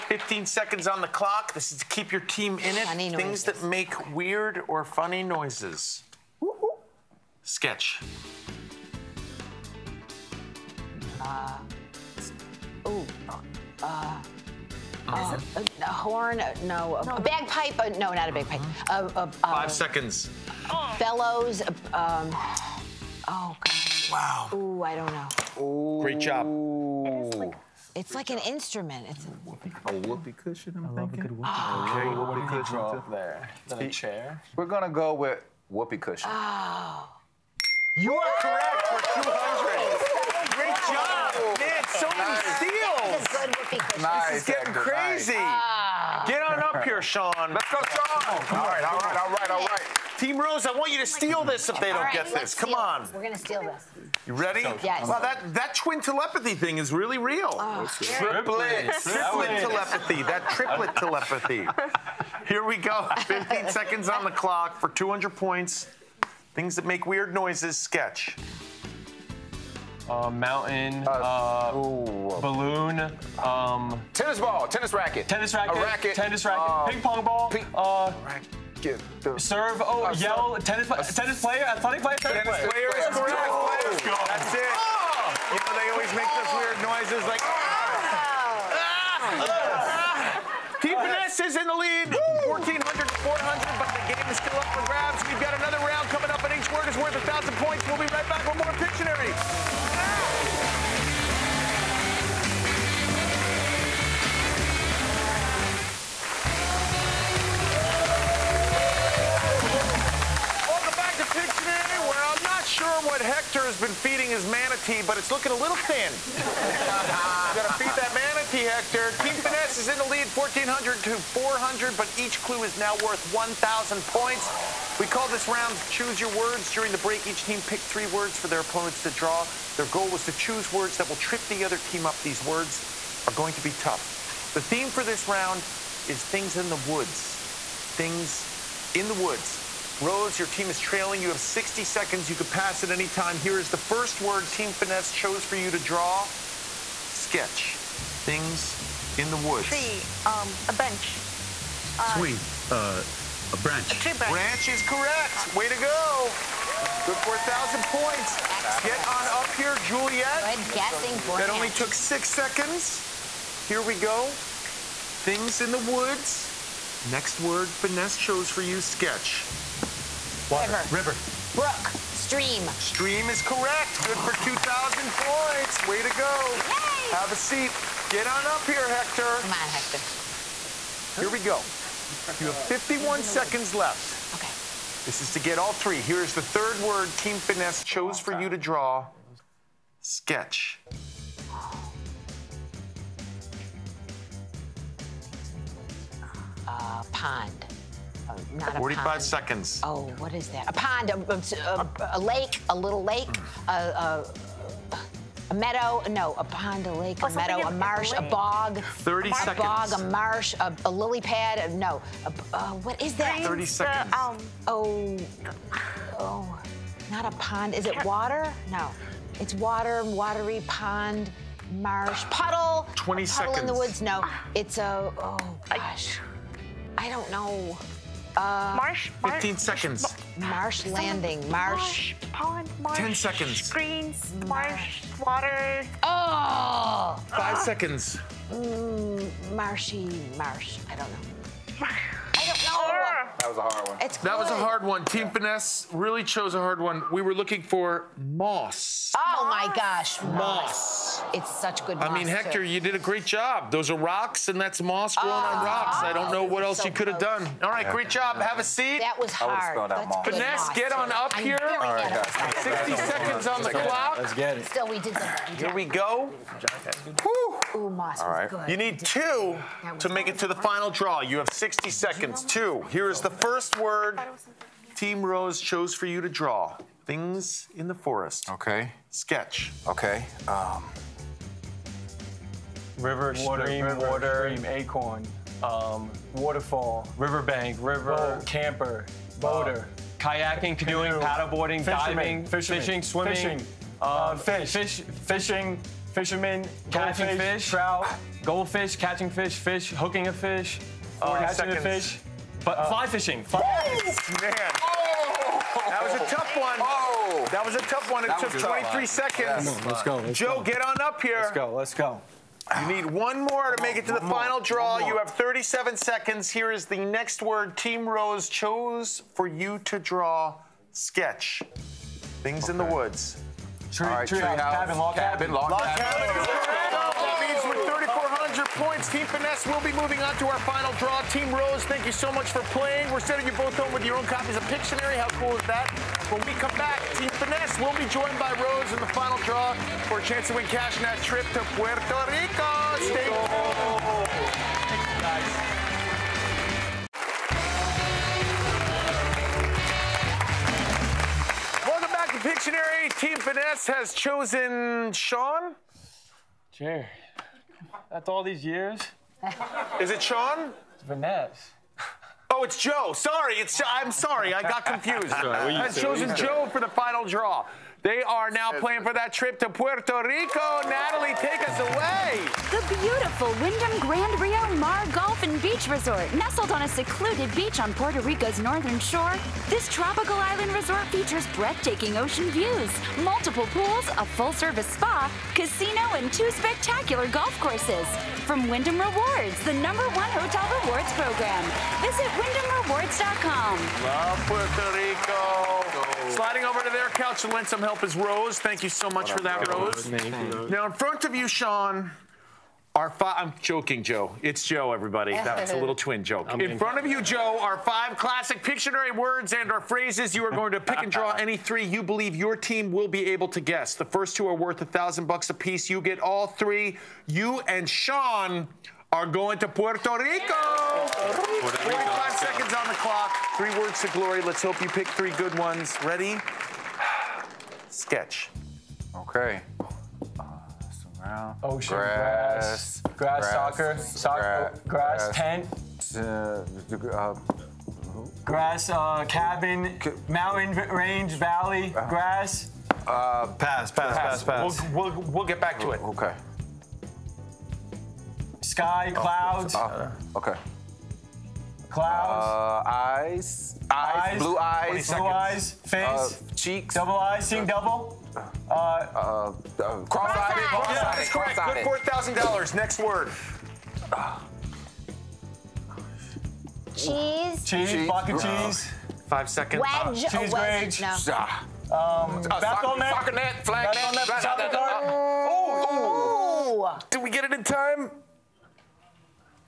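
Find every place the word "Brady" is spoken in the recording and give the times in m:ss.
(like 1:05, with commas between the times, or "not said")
not said.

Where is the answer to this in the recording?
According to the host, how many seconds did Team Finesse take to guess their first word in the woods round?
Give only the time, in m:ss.
5:08.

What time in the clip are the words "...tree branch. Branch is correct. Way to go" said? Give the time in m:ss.
2:33.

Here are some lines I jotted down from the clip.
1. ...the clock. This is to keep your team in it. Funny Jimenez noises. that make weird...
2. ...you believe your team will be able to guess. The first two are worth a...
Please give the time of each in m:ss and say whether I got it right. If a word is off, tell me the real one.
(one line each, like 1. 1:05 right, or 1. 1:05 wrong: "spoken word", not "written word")
1. 0:00 wrong: "Things", not "Jimenez"
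2. 6:51 right.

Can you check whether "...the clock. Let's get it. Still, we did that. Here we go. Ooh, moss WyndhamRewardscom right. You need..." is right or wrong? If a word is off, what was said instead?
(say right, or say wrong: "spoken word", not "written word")
wrong: "All", not "WyndhamRewardscom".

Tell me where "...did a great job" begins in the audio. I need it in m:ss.
4:12.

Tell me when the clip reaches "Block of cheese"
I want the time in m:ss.
7:48.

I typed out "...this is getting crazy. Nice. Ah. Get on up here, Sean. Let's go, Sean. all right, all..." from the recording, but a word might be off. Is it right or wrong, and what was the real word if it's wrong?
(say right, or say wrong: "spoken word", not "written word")
right.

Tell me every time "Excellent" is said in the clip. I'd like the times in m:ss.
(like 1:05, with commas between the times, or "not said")
2:38.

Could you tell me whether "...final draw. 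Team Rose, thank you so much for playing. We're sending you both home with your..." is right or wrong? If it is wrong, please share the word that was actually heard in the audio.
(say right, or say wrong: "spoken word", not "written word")
right.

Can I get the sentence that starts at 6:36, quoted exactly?
Sliding over to their couch to lend some help is Rose.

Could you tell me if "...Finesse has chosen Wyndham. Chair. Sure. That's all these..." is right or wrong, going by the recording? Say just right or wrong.
wrong.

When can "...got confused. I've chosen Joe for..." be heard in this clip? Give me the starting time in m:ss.
6:04.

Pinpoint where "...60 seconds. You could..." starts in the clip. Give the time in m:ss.
2:21.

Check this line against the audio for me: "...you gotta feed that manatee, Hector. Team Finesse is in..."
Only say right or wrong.
right.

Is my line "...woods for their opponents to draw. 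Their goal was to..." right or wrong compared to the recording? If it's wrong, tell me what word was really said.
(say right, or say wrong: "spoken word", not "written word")
wrong: "words", not "woods".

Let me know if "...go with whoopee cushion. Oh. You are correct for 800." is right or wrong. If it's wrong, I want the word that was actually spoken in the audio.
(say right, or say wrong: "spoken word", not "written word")
wrong: "200", not "800".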